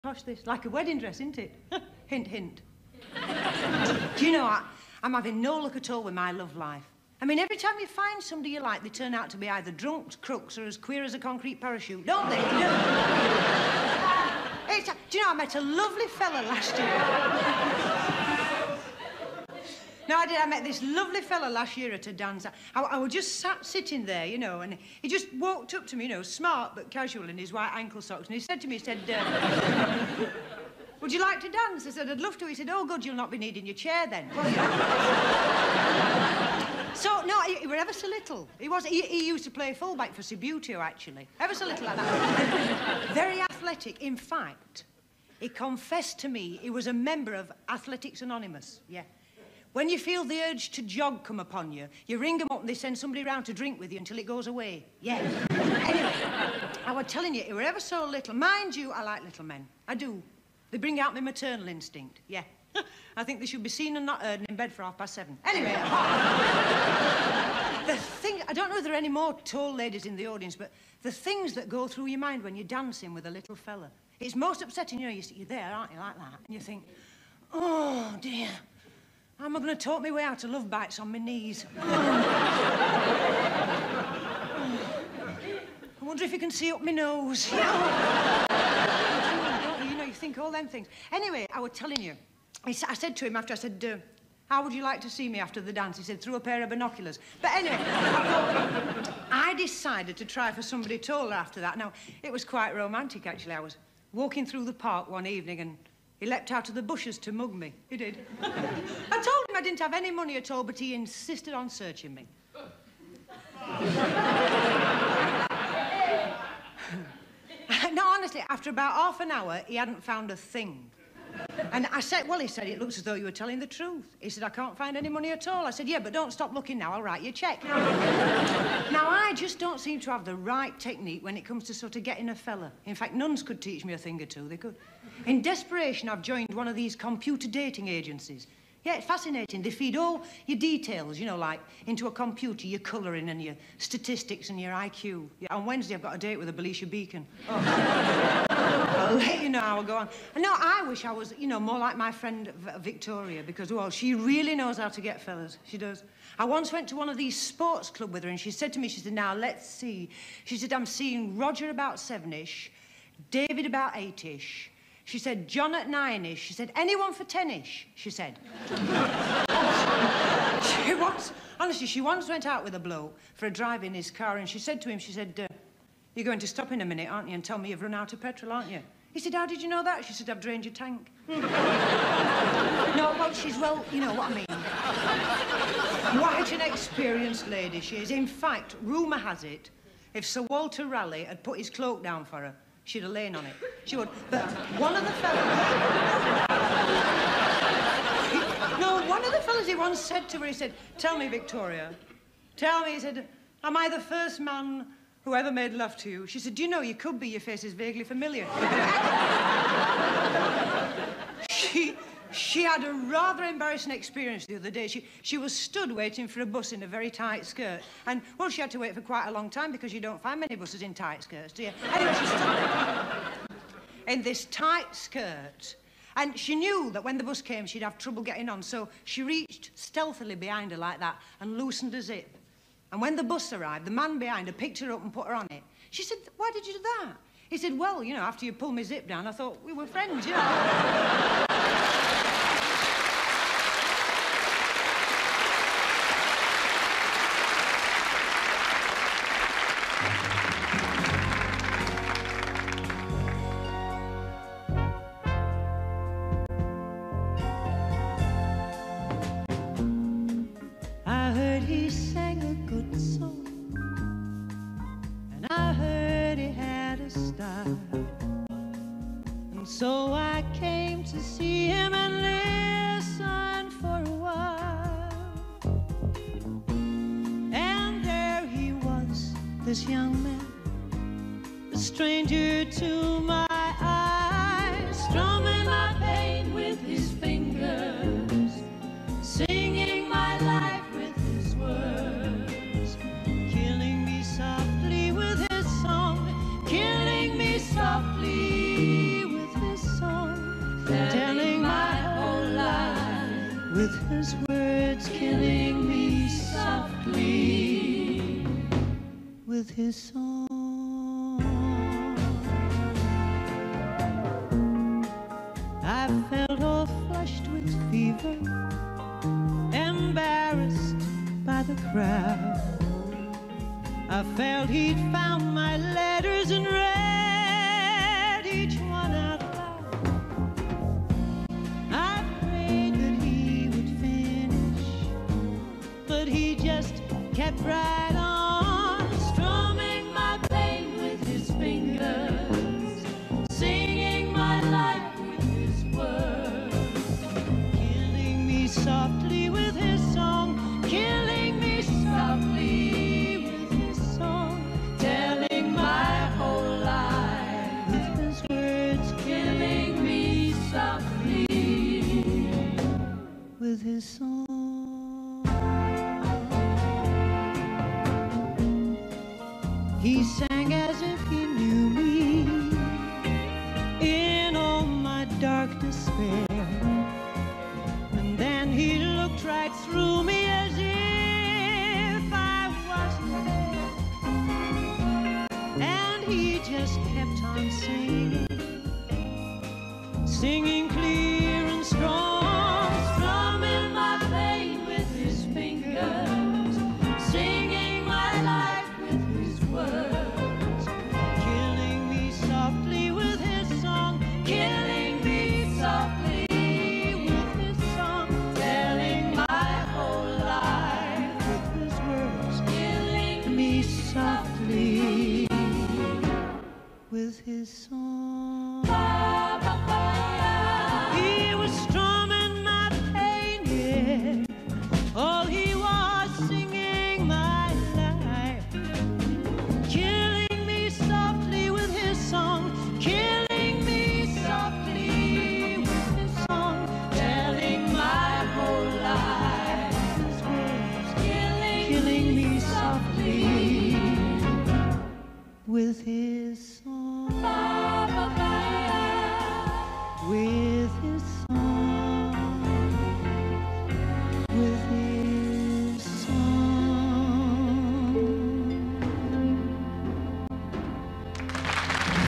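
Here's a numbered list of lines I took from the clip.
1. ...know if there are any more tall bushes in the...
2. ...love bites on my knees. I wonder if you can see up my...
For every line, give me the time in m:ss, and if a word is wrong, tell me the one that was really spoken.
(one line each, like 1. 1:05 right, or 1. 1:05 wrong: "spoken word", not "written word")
1. 1:08 wrong: "ladies", not "bushes"
2. 1:20 right.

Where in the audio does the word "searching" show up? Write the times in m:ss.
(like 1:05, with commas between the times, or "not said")
1:51.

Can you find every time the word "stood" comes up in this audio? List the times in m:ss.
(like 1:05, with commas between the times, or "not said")
3:35, 3:42.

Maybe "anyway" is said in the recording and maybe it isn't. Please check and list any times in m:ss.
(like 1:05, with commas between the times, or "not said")
0:55, 1:05, 1:31, 1:37, 3:41.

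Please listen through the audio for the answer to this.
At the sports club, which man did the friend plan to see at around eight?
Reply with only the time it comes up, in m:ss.
2:43.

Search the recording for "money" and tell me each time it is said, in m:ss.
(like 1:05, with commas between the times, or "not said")
1:50, 2:05.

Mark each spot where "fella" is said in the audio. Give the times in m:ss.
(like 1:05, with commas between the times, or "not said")
0:16, 0:21, 1:13, 2:12, 2:35, 3:15, 3:19.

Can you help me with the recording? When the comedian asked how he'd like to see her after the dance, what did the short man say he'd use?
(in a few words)
a pair of binoculars.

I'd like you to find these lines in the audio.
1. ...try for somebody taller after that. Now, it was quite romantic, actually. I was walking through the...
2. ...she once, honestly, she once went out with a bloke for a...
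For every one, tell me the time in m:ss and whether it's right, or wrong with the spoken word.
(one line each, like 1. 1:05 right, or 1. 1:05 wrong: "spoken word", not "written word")
1. 1:40 right
2. 2:50 right.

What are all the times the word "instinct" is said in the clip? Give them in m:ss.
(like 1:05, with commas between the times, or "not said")
1:01.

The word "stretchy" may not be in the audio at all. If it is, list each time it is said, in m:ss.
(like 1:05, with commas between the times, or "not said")
not said.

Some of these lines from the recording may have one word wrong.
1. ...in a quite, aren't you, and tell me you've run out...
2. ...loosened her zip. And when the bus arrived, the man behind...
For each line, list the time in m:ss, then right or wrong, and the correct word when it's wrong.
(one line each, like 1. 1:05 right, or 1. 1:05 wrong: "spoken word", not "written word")
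1. 2:56 wrong: "minute", not "quite"
2. 3:51 right.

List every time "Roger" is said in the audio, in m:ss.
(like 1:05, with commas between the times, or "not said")
2:41.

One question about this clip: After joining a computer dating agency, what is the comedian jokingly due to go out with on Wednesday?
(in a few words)
a Belisha Beacon.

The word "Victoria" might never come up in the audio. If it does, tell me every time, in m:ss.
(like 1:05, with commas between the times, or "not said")
2:32, 3:21.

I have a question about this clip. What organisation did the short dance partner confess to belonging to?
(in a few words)
Athletics Anonymous.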